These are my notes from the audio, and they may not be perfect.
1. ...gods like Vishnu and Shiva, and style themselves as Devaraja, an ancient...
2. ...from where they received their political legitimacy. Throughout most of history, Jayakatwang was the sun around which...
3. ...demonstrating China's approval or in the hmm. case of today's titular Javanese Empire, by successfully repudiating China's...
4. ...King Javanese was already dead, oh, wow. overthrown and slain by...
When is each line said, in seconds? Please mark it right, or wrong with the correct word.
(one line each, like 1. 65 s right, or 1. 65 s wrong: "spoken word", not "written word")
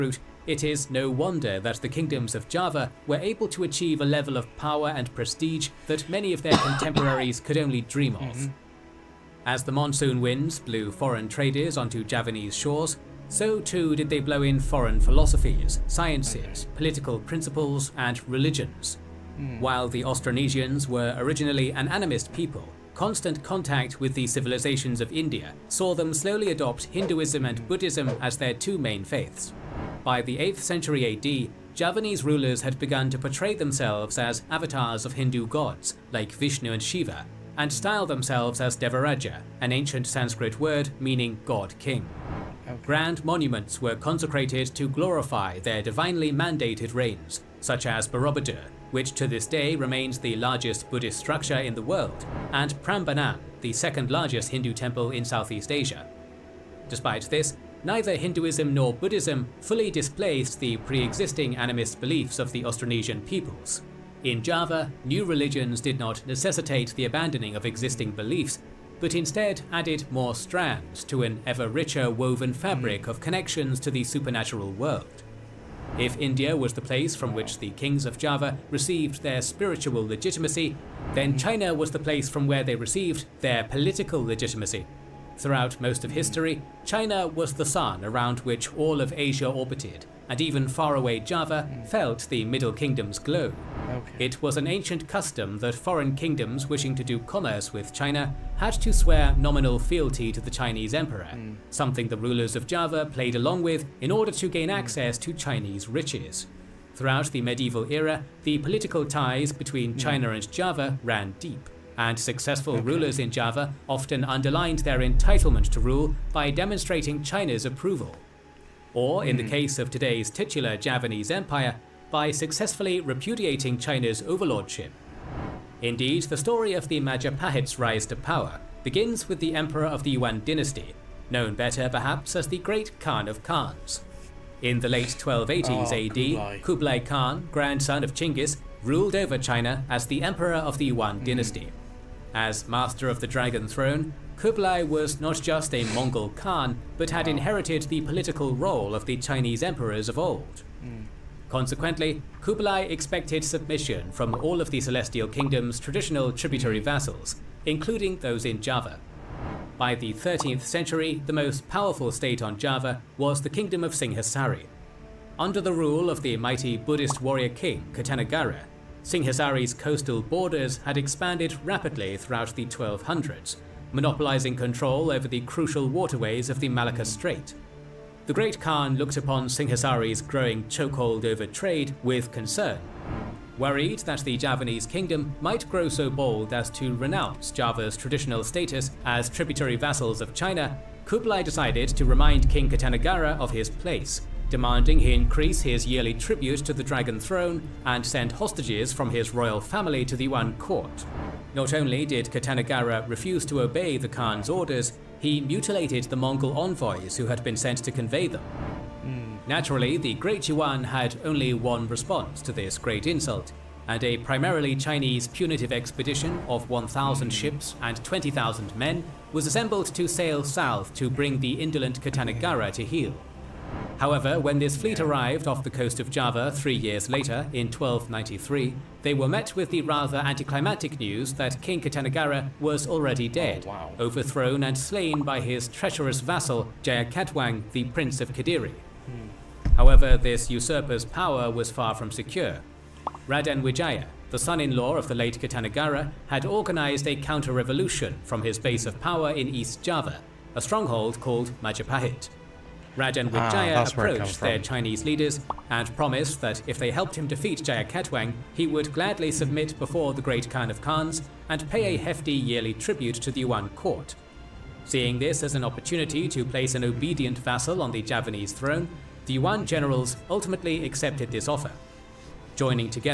1. 35 s right
2. 82 s wrong: "China", not "Jayakatwang"
3. 116 s right
4. 231 s wrong: "Katanagara", not "Javanese".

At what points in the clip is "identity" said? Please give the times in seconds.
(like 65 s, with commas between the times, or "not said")
not said.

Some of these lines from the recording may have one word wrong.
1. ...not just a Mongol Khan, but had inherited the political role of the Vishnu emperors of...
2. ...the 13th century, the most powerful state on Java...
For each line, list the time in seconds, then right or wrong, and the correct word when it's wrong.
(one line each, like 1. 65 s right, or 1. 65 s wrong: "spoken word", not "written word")
1. 145 s wrong: "Chinese", not "Vishnu"
2. 159 s right.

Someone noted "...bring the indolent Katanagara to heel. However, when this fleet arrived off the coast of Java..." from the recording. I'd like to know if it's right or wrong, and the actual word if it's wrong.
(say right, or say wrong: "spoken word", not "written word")
right.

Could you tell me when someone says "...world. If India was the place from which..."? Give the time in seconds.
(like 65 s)
74 s.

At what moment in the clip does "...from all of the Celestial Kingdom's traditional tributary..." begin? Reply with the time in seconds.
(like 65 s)
154 s.